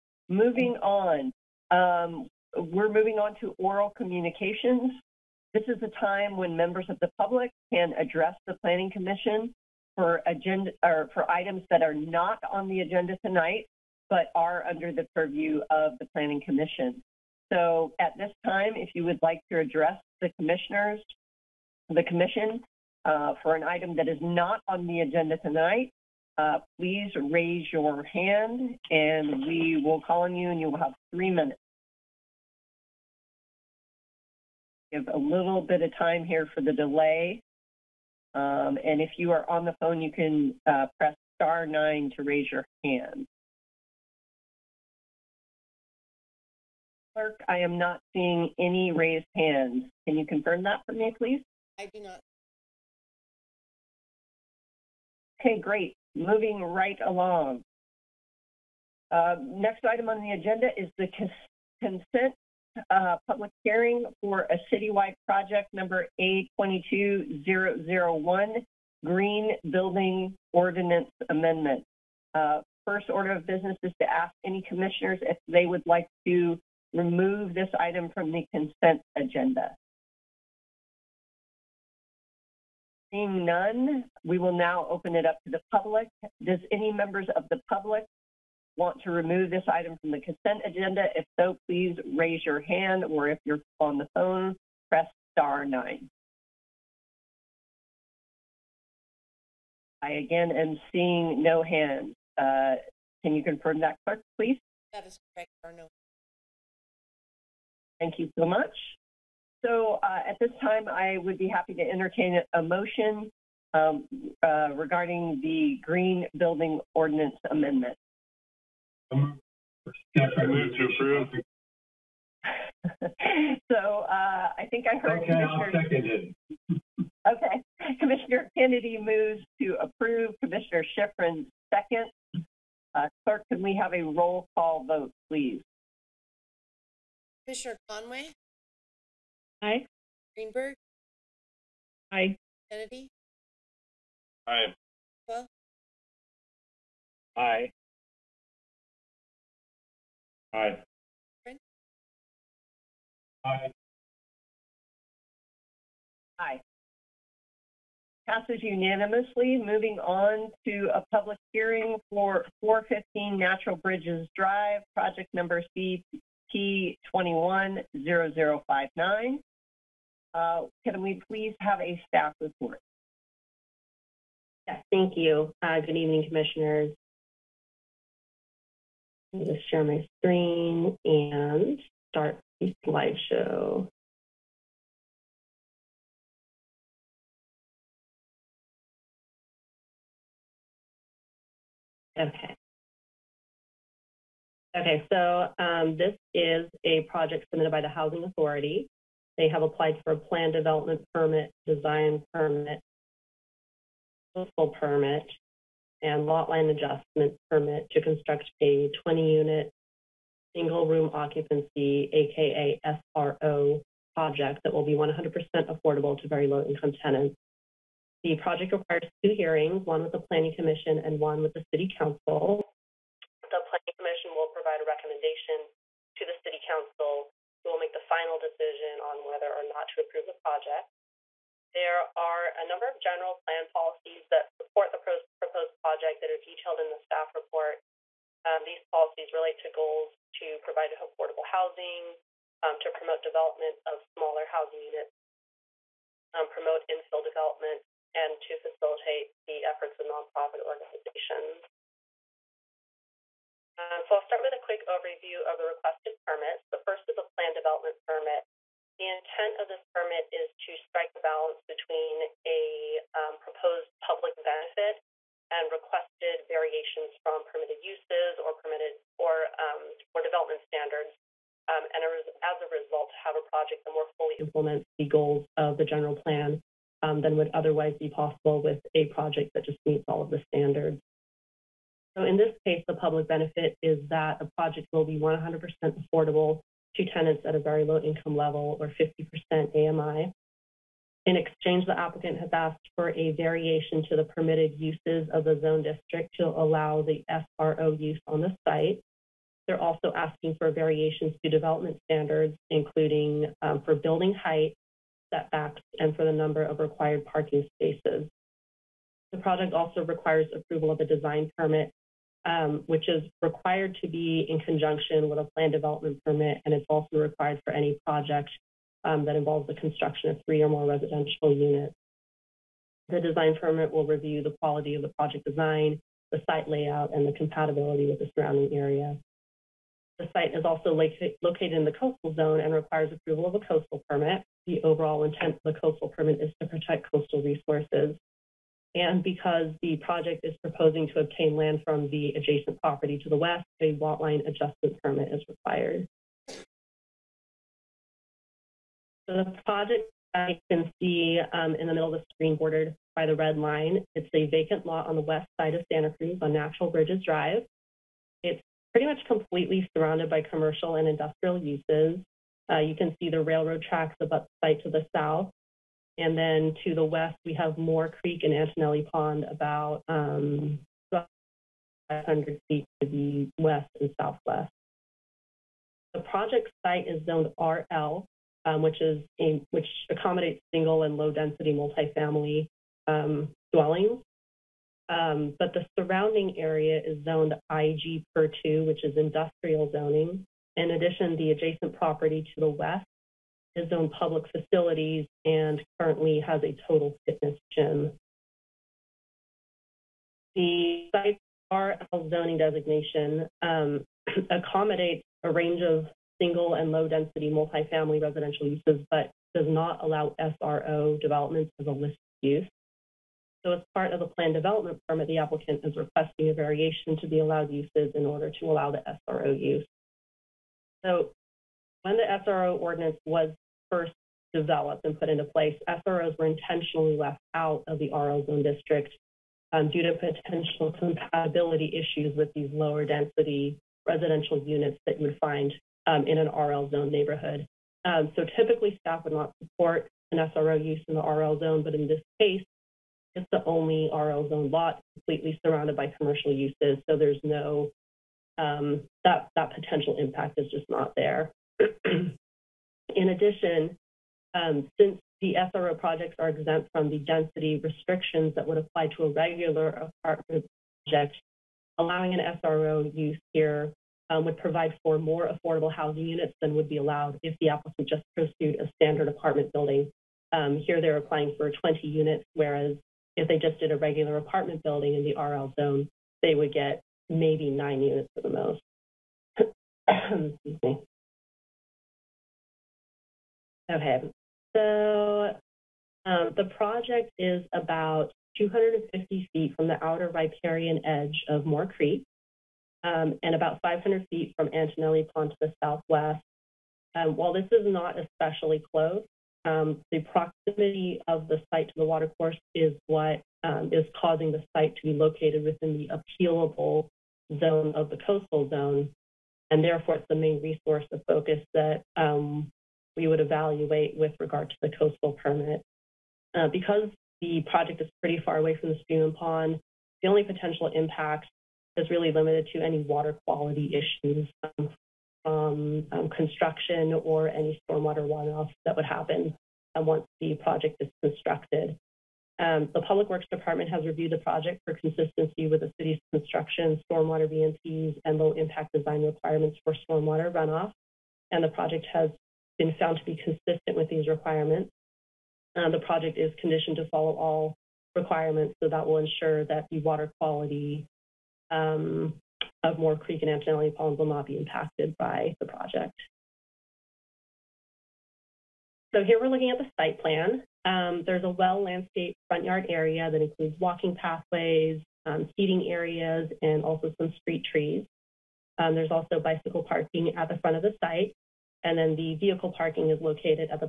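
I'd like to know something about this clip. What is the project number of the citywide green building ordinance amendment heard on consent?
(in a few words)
A22001.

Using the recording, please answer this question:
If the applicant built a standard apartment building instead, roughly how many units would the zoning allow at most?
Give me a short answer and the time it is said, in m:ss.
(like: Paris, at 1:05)
9, at 7:57.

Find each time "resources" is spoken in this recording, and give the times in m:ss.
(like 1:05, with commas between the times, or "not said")
5:37, 8:30.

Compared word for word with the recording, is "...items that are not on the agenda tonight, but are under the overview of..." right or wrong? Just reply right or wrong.
wrong.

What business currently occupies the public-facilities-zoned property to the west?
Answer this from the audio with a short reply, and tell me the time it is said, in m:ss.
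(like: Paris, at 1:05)
Total fitness gym, at 6:36.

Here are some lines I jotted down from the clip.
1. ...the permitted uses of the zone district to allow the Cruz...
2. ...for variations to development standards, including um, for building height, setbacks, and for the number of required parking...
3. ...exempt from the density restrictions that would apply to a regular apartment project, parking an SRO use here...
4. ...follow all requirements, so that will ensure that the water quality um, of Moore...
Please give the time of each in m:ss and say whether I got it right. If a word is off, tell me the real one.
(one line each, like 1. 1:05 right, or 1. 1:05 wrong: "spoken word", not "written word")
1. 4:54 wrong: "SRO", not "Cruz"
2. 5:00 right
3. 7:36 wrong: "allowing", not "parking"
4. 9:07 right.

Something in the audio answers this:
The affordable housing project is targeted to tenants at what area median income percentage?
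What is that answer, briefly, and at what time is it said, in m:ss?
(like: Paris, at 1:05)
50%, at 4:49.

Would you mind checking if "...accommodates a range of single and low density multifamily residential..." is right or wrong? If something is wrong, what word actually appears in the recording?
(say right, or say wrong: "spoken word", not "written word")
right.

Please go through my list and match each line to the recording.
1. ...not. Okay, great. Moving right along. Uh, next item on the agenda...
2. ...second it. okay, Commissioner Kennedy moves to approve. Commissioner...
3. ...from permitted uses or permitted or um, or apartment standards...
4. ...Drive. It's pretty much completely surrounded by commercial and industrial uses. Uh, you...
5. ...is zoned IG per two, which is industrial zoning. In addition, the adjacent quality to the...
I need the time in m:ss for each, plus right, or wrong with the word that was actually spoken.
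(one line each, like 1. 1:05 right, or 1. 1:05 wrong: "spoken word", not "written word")
1. 0:52 right
2. 2:05 right
3. 4:27 wrong: "development", not "apartment"
4. 5:57 right
5. 6:27 wrong: "property", not "quality".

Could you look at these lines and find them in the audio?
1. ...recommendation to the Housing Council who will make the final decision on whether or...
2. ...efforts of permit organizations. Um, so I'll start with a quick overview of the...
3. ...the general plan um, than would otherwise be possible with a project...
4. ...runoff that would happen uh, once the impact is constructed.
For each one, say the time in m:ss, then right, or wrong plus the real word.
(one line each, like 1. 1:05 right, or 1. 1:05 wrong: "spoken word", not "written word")
1. 3:44 wrong: "City", not "Housing"
2. 4:09 wrong: "nonprofit", not "permit"
3. 4:35 right
4. 8:48 wrong: "project", not "impact".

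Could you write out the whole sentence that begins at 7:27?
So there's no, um, that, that potential impact is just not there.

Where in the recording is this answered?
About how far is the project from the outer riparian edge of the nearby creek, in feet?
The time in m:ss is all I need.
8:08.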